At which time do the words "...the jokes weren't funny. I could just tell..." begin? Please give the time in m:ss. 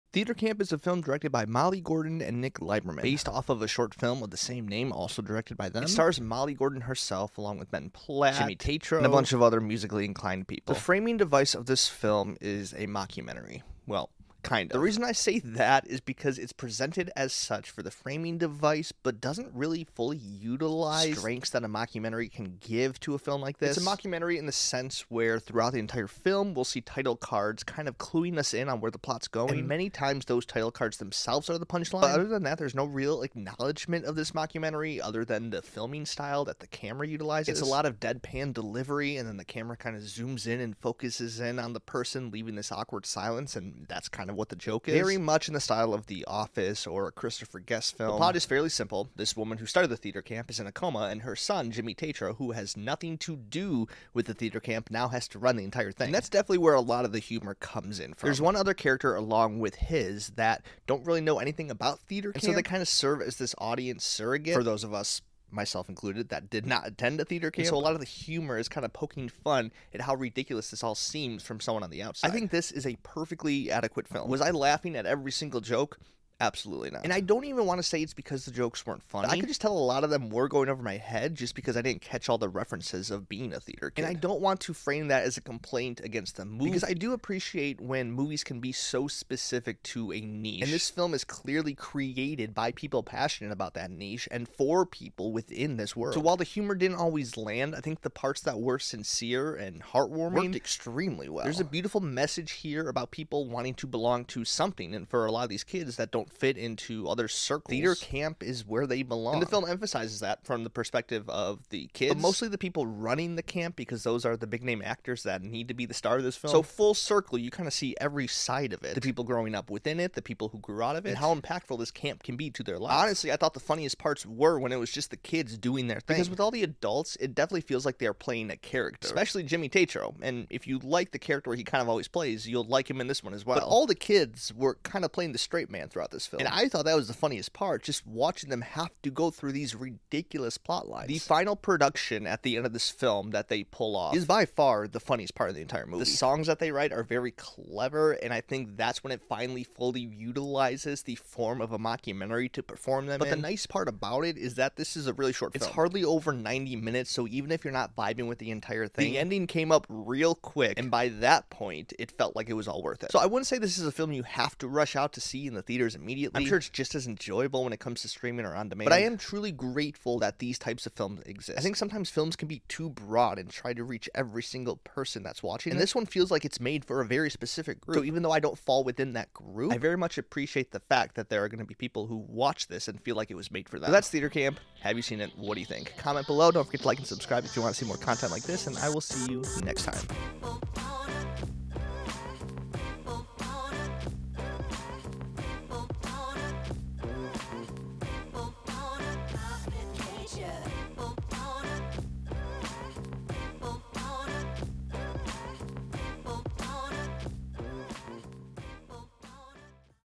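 1:18.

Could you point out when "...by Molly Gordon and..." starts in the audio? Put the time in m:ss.
0:01.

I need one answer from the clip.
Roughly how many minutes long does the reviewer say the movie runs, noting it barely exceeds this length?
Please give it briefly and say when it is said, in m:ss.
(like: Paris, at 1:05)
90, at 2:36.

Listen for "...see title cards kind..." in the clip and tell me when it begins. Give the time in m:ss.
0:26.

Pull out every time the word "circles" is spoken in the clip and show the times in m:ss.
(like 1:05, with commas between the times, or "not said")
1:47, 1:56.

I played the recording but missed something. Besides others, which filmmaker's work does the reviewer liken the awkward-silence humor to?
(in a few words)
Christopher Guest.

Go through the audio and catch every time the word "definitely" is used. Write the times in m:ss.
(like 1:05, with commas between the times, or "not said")
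0:56, 2:07.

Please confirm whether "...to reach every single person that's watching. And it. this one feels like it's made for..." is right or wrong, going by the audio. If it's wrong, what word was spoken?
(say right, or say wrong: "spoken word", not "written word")
right.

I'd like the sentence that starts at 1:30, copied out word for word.
And this film is clearly created by people passionate about that niche and for people within this world.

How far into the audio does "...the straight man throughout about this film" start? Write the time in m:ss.
2:15.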